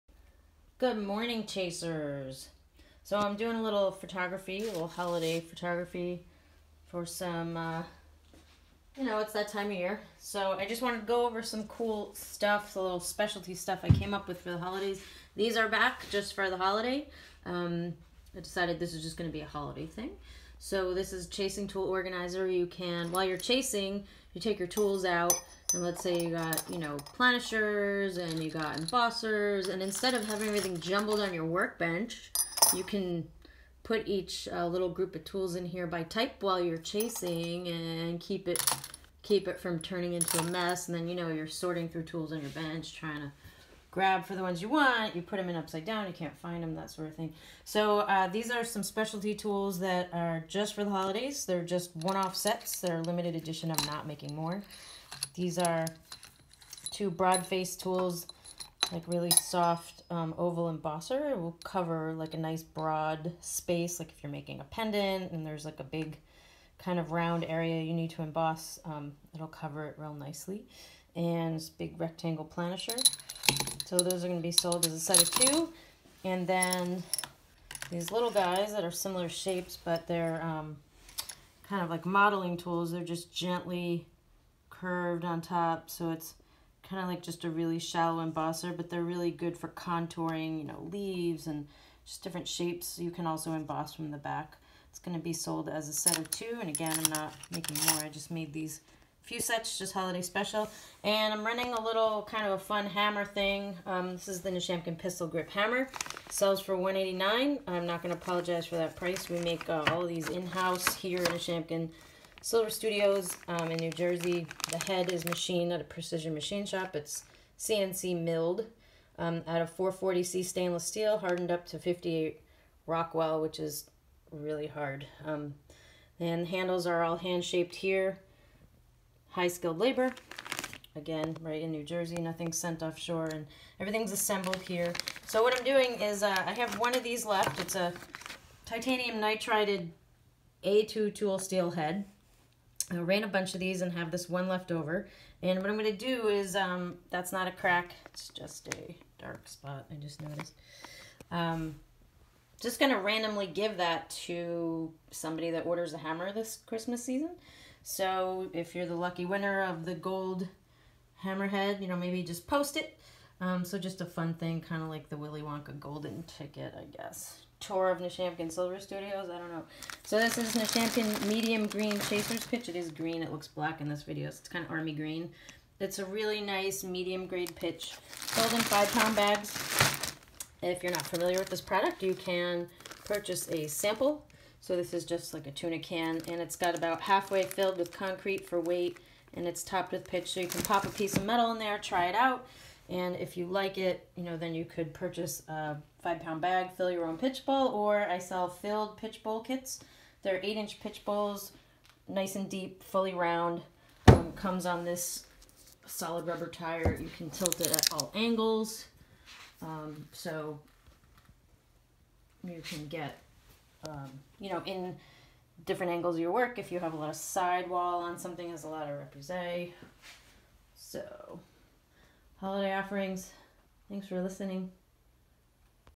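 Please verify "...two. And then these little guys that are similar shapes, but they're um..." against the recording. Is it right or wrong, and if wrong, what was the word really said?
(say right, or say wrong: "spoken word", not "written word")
right.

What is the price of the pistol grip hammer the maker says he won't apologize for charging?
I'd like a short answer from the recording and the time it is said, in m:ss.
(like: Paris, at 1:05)
189, at 1:46.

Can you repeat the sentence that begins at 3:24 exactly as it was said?
Um, comes on this solid rubber tire.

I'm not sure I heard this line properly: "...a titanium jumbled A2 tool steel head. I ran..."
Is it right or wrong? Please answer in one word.
wrong.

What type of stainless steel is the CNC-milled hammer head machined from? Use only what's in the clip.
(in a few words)
440C.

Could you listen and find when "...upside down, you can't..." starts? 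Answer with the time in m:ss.
0:45.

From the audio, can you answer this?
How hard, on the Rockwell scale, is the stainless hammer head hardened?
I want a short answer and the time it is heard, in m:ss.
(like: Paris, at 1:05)
58 Rockwell, at 2:01.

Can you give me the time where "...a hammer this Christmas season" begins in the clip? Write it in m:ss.
2:35.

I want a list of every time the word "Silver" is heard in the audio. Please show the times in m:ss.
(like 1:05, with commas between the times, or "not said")
1:52, 2:48.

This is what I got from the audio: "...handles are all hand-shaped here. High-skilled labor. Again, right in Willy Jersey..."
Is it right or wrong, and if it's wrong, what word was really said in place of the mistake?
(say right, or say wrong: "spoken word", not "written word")
wrong: "New", not "Willy".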